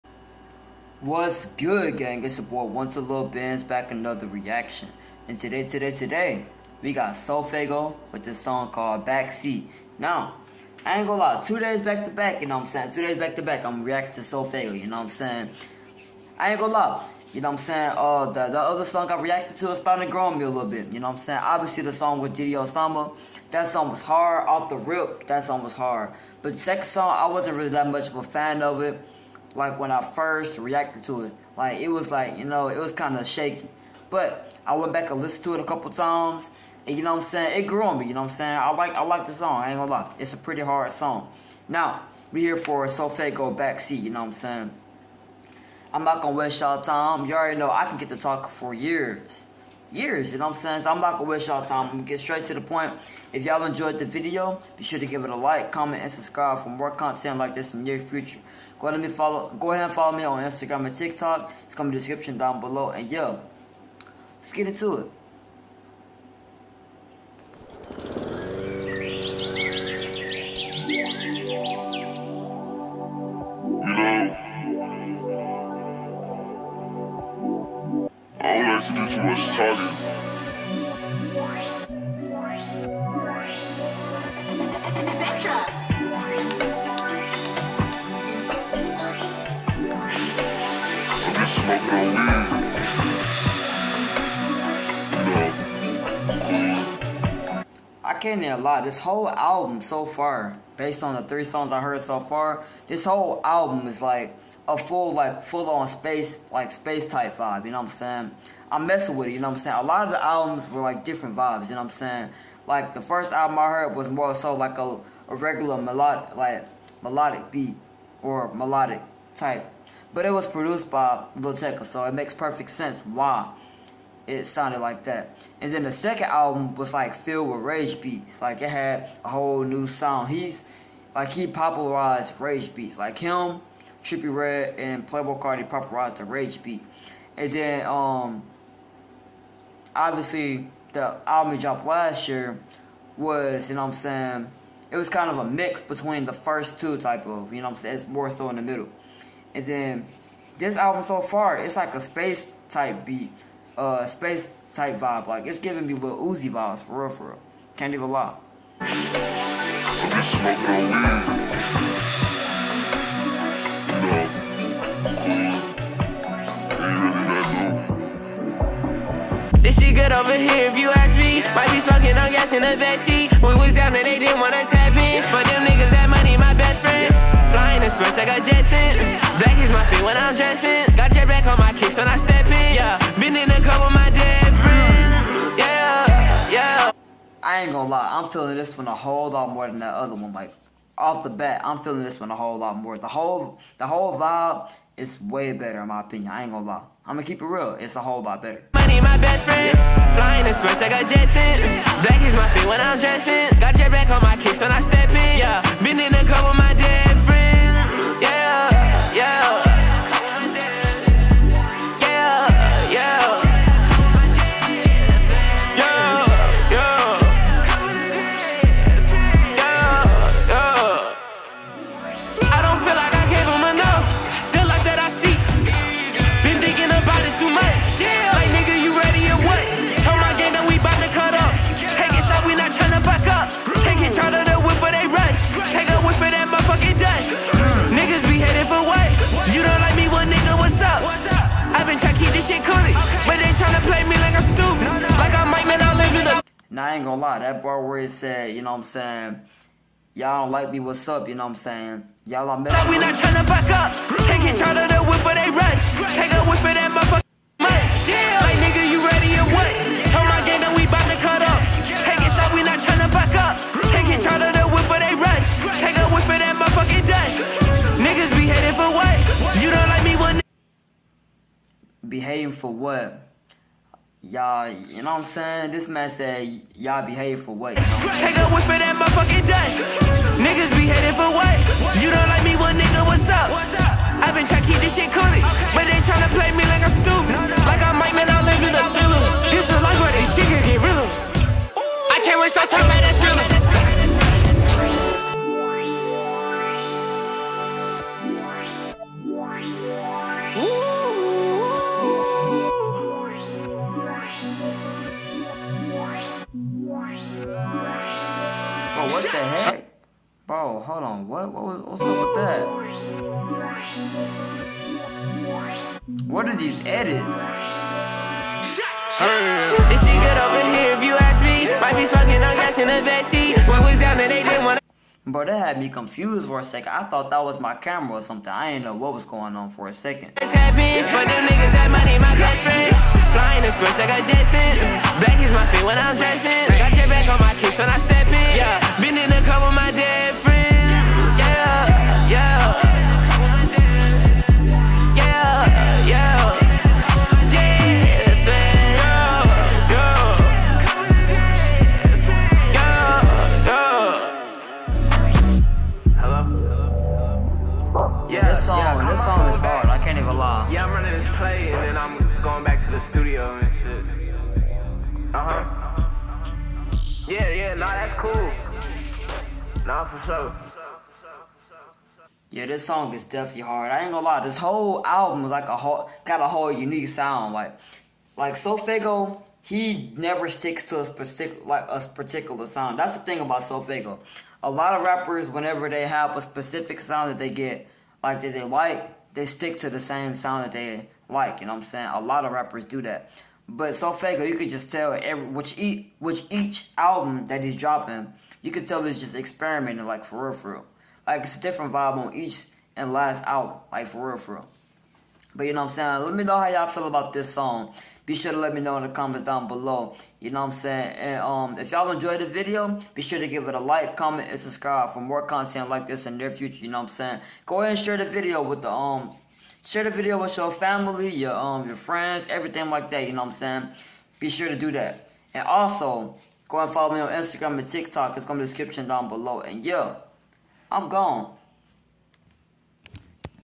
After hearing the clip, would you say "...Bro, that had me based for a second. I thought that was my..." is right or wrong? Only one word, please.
wrong.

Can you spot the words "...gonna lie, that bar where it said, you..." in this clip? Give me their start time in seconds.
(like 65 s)
247 s.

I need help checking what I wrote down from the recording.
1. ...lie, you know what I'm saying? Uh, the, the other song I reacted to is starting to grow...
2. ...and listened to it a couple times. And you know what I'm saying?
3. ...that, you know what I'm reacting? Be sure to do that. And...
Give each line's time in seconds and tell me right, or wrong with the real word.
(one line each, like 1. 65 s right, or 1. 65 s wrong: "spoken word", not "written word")
1. 16 s right
2. 35 s right
3. 423 s wrong: "saying", not "reacting".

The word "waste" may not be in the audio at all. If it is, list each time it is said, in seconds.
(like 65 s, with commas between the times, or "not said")
46 s, 51 s.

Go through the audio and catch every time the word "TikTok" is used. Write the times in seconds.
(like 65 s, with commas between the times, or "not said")
60 s, 427 s.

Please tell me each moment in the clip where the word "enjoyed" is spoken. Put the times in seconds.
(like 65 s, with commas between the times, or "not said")
53 s, 412 s.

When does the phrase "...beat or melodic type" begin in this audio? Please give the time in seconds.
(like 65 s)
117 s.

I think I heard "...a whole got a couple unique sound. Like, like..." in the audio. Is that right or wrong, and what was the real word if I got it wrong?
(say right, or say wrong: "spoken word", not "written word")
wrong: "whole", not "couple".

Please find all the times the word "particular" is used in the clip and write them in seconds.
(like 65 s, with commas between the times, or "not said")
382 s.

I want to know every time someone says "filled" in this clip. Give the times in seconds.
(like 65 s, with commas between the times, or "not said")
127 s.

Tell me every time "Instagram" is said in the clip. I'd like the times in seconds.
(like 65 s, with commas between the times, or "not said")
60 s, 427 s.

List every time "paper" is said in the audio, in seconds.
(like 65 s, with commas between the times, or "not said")
not said.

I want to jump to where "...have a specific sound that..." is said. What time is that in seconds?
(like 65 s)
386 s.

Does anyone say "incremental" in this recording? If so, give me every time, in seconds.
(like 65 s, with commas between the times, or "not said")
not said.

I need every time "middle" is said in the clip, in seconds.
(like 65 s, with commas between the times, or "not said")
148 s.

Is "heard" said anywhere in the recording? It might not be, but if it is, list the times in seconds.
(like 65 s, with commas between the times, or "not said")
101 s, 113 s.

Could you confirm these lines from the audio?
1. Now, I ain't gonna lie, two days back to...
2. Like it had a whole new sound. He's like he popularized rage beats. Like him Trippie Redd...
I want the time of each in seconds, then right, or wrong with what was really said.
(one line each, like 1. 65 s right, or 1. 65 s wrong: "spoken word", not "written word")
1. 9 s right
2. 128 s right.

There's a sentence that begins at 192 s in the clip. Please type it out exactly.
The whole the whole vibe it's way better in my opinion.